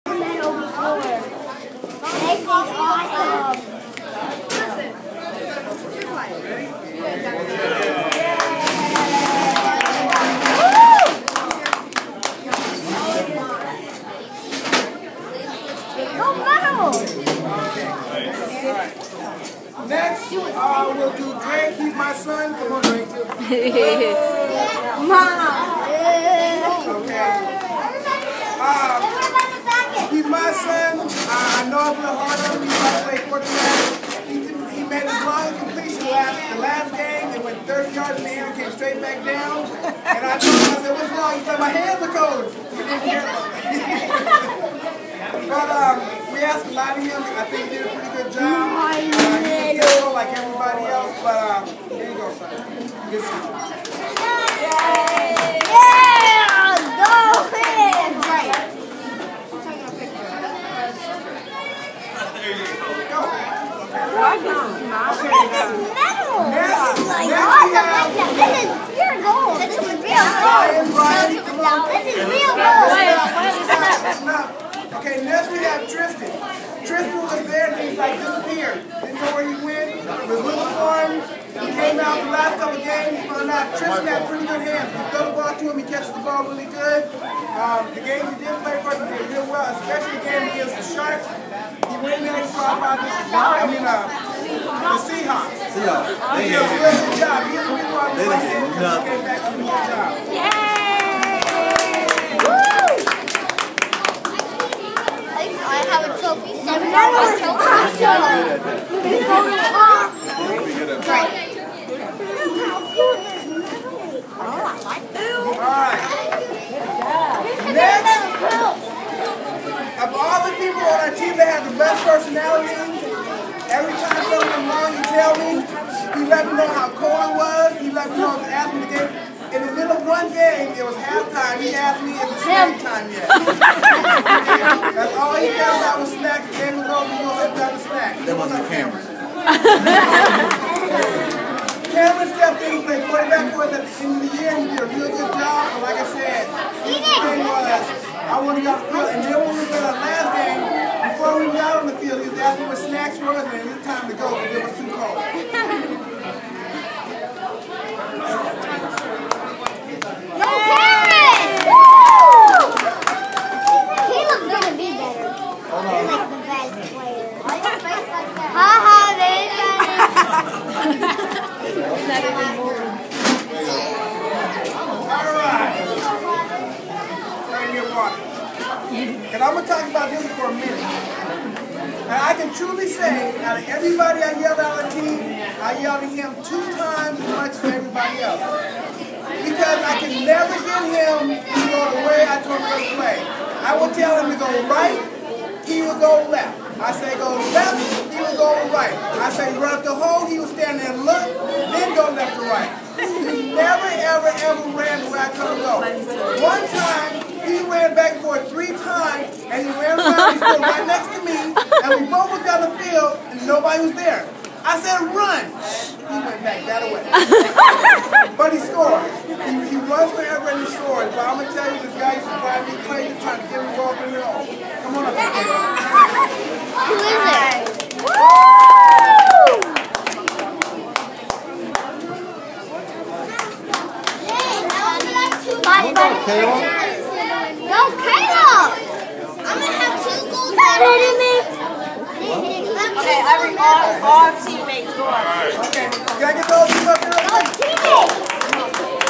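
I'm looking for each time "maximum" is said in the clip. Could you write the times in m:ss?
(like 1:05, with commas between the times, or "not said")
not said.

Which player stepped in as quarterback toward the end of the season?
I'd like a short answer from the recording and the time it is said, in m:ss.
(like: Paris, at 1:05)
Cameron, at 2:21.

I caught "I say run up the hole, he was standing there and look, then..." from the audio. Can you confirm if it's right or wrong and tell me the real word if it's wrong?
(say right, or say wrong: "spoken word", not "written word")
right.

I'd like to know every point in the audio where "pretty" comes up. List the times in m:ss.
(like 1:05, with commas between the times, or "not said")
0:47, 1:24.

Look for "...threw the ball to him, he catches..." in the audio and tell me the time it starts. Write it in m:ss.
1:25.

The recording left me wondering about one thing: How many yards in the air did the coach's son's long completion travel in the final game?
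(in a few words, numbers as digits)
30.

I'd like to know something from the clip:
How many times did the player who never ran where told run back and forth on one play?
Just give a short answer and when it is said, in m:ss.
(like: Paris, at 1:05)
3, at 3:28.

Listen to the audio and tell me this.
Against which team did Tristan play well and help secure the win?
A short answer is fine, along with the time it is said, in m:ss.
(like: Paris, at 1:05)
Seahawks, at 1:33.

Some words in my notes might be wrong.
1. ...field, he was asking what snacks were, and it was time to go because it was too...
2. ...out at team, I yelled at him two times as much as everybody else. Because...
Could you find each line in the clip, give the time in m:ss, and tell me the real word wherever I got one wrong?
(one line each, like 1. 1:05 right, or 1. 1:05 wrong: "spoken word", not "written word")
1. 2:31 right
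2. 3:04 right.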